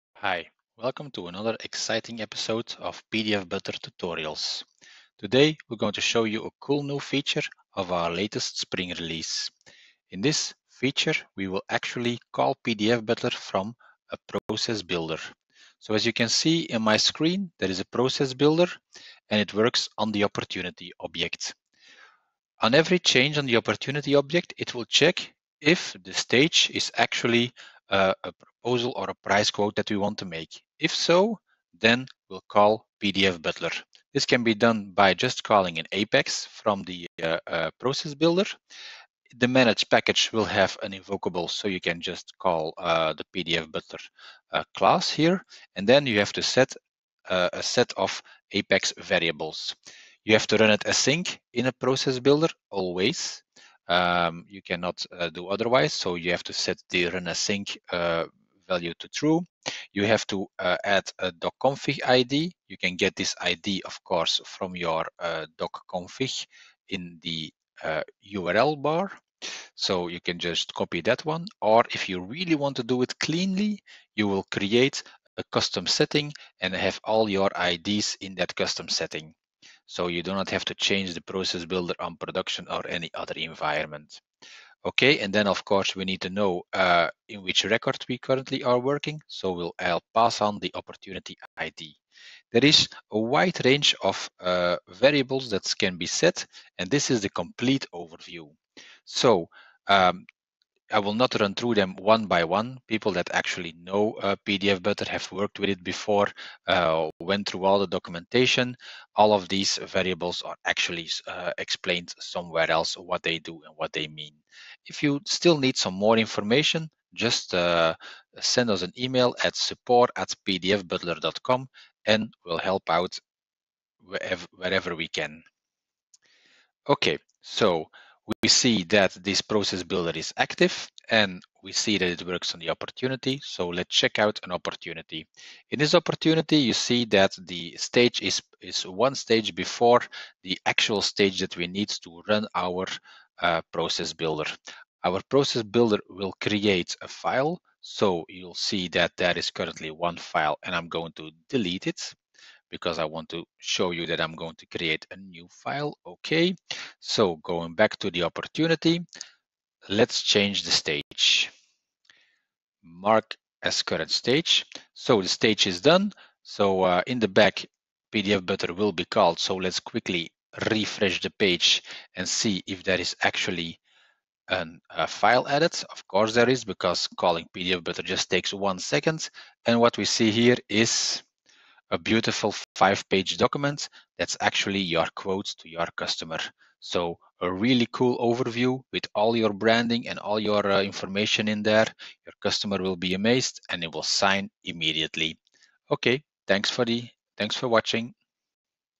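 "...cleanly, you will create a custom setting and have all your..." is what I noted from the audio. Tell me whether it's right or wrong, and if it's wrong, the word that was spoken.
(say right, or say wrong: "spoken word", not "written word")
right.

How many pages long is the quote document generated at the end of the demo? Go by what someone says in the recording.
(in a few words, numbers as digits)
5.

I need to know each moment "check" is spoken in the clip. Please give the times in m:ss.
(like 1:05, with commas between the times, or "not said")
0:24, 2:13.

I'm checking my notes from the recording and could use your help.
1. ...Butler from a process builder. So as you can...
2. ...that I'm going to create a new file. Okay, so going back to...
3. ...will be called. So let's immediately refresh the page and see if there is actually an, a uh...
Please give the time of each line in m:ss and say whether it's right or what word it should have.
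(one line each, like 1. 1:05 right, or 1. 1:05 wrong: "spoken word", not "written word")
1. 0:13 right
2. 2:34 right
3. 2:48 wrong: "quickly", not "immediately".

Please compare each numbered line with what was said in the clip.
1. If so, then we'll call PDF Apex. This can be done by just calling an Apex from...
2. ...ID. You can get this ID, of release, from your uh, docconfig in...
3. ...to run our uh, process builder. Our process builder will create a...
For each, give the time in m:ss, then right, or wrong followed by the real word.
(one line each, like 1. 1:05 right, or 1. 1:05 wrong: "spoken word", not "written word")
1. 0:30 wrong: "Butler", not "Apex"
2. 1:02 wrong: "course", not "release"
3. 2:21 right.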